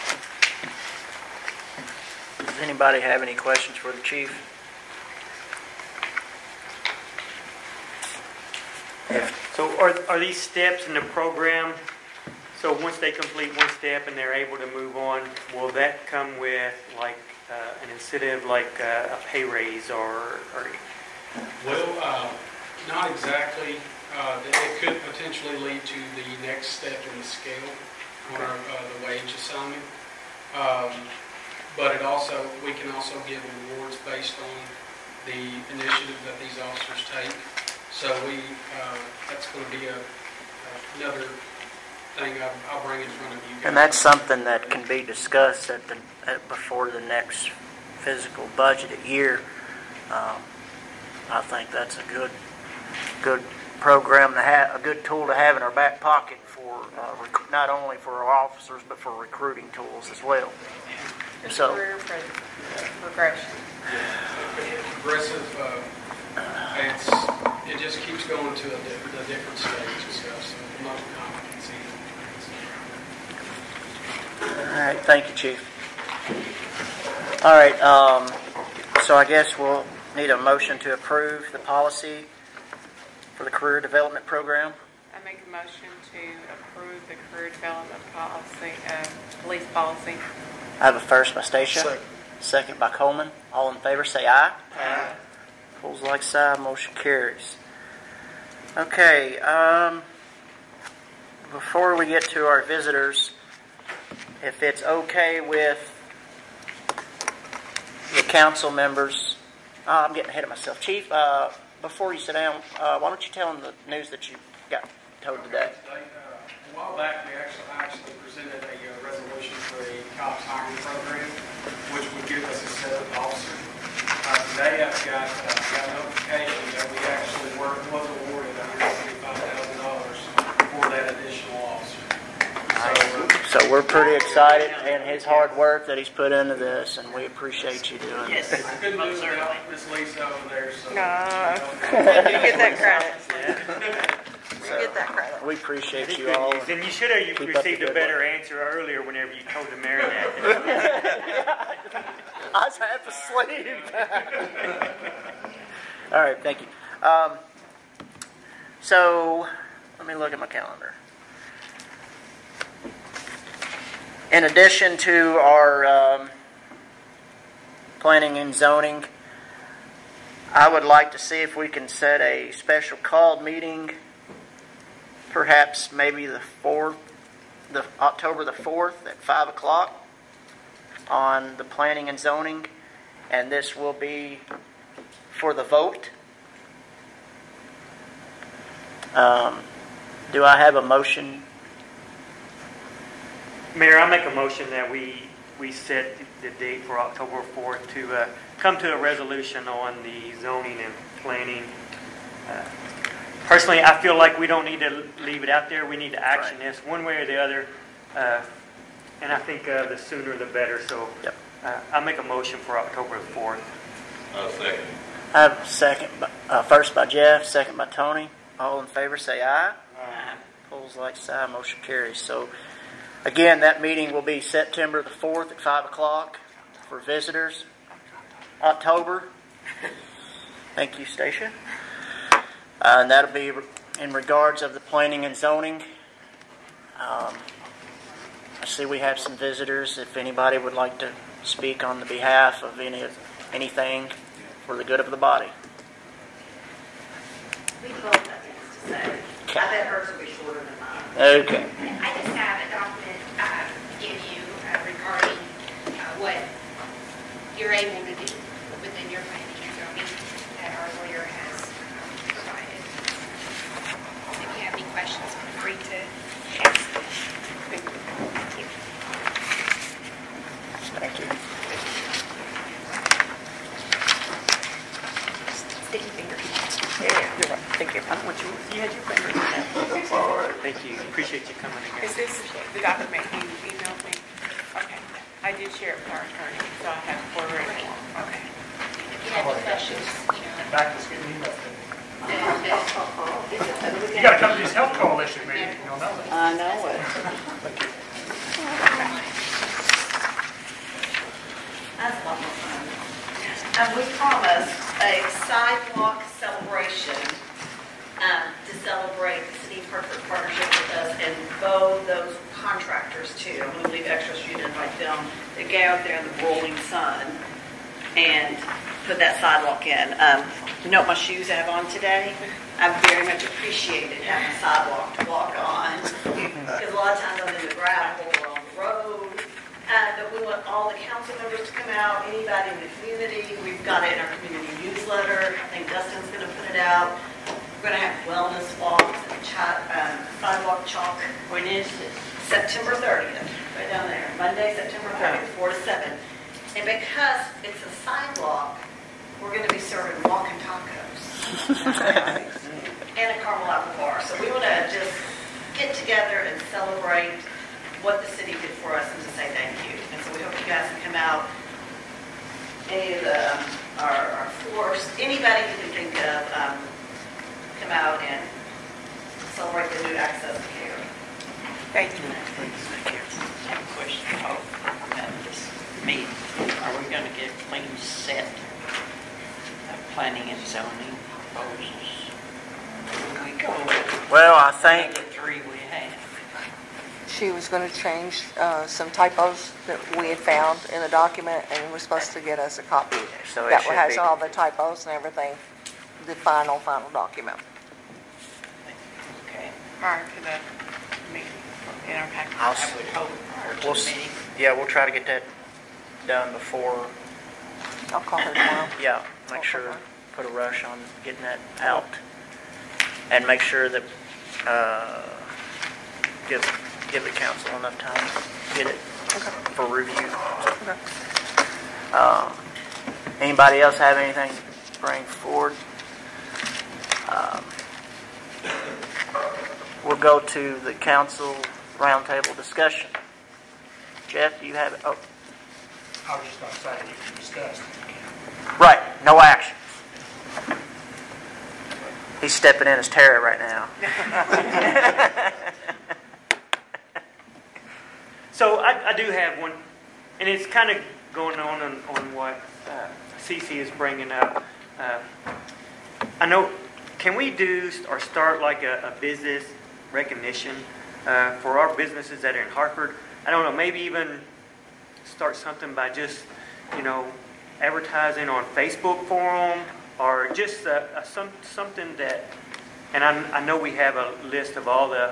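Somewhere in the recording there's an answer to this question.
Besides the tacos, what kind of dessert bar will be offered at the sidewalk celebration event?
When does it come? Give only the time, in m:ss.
5:53.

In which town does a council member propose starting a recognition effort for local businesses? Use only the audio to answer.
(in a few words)
Hartford.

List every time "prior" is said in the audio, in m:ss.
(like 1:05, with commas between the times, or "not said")
6:39.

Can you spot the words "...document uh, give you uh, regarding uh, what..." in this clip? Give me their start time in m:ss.
4:12.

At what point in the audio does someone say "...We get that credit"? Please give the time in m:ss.
2:24.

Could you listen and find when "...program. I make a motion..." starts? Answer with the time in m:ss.
1:24.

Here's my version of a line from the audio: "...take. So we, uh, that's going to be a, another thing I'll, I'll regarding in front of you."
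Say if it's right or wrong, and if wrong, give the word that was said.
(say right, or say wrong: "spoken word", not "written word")
wrong: "bring", not "regarding".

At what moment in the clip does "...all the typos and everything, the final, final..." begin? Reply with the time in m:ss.
6:34.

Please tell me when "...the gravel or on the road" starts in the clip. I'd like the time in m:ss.
5:27.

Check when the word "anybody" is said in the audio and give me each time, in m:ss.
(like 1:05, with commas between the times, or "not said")
0:02, 4:00, 5:32, 6:05, 7:03.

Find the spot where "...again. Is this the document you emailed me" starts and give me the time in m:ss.
4:41.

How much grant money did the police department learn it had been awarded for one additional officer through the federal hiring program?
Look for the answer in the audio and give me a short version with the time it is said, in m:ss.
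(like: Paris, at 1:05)
$135,000, at 2:08.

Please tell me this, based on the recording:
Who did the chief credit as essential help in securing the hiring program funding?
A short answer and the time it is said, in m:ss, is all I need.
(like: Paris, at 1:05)
Miss Lisa, at 2:19.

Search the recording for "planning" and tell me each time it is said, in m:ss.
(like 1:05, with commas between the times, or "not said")
2:47, 3:01, 3:21, 3:54, 6:20.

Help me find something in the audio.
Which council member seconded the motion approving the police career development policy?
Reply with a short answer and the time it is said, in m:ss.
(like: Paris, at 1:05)
Coleman, at 1:32.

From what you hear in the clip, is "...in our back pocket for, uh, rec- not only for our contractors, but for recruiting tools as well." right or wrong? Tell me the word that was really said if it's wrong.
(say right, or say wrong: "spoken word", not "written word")
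wrong: "officers", not "contractors".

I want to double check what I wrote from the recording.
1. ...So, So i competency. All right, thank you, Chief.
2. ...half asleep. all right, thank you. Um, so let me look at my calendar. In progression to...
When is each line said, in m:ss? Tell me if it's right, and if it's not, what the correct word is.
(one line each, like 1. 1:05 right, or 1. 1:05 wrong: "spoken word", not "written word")
1. 1:10 right
2. 2:32 wrong: "addition", not "progression".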